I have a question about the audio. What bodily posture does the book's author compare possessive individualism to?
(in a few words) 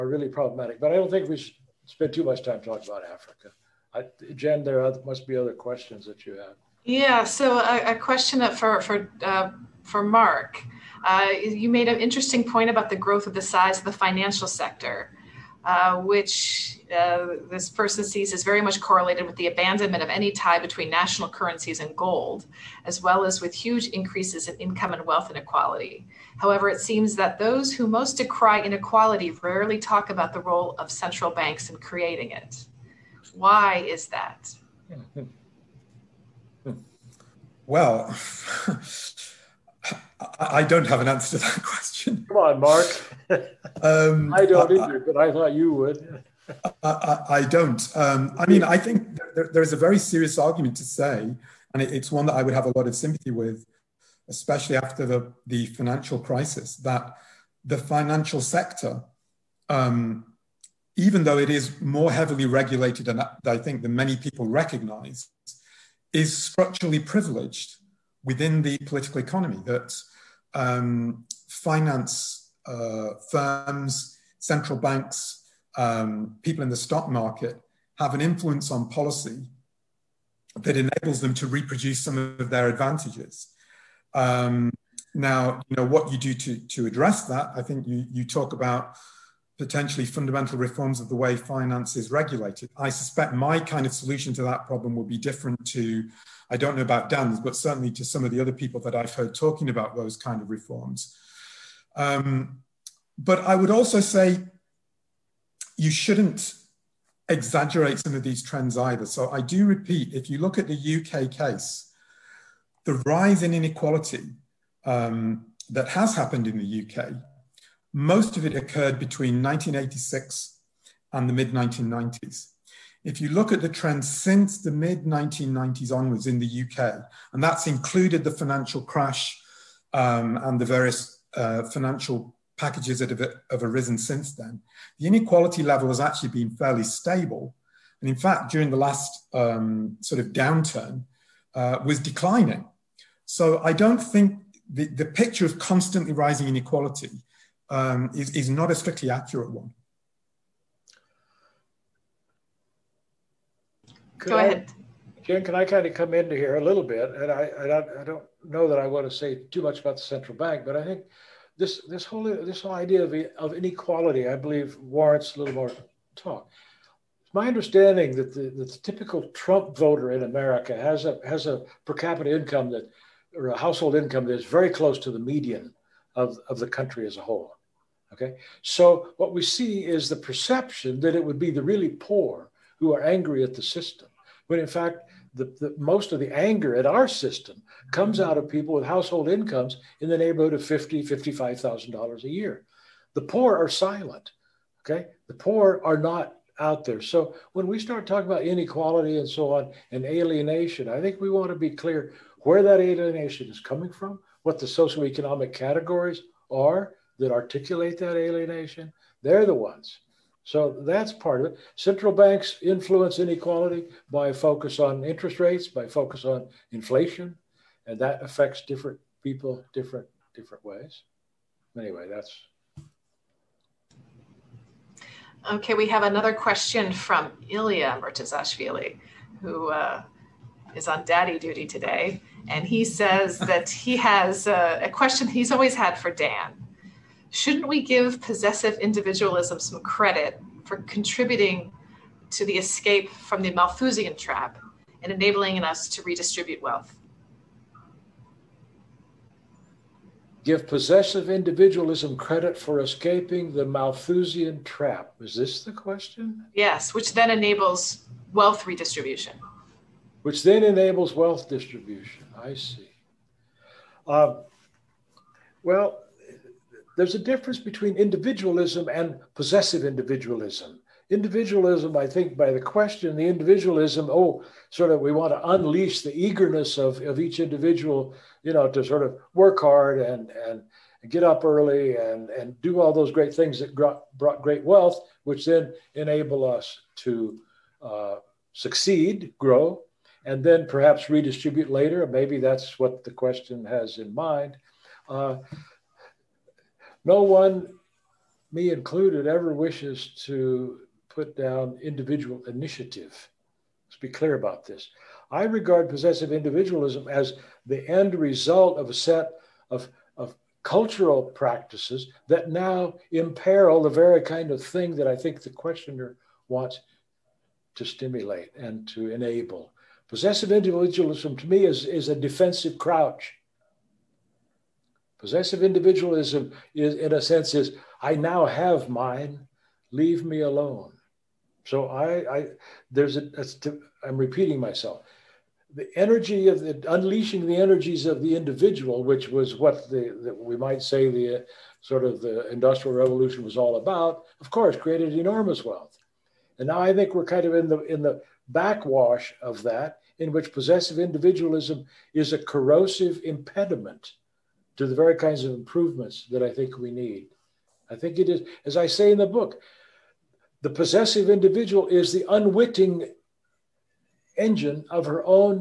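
a defensive crouch.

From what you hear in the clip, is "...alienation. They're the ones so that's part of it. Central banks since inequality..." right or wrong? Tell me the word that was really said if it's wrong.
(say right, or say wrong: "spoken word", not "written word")
wrong: "influence", not "since".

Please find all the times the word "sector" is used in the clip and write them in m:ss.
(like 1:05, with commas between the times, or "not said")
0:14, 0:58.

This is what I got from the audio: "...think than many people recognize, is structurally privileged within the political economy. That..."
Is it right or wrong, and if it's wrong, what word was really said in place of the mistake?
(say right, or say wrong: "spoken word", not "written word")
right.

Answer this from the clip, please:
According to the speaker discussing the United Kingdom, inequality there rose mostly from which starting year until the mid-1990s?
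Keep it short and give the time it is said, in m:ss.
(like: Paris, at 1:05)
1986, at 1:59.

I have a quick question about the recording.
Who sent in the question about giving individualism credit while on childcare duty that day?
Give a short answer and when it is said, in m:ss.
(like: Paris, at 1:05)
Ilya Murtazashvili, at 3:47.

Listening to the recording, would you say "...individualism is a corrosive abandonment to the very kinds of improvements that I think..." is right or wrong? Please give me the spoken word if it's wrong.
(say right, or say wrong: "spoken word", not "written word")
wrong: "impediment", not "abandonment".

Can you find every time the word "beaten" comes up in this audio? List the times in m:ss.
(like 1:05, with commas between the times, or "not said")
not said.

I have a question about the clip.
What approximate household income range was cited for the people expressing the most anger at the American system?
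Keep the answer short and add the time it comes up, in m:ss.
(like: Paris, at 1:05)
$50,000-$55,000 a year, at 3:10.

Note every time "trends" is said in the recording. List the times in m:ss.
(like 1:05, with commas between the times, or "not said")
1:48, 2:03.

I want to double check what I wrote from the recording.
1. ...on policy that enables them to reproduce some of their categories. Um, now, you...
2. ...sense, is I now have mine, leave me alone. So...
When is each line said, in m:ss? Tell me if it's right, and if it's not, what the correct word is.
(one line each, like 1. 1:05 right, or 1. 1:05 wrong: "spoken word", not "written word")
1. 1:18 wrong: "advantages", not "categories"
2. 5:27 right.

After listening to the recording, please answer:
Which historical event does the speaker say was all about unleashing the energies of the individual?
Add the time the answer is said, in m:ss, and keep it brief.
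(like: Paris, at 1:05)
the industrial revolution, at 5:42.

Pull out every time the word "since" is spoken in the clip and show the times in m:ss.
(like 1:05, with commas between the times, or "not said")
2:04, 2:13.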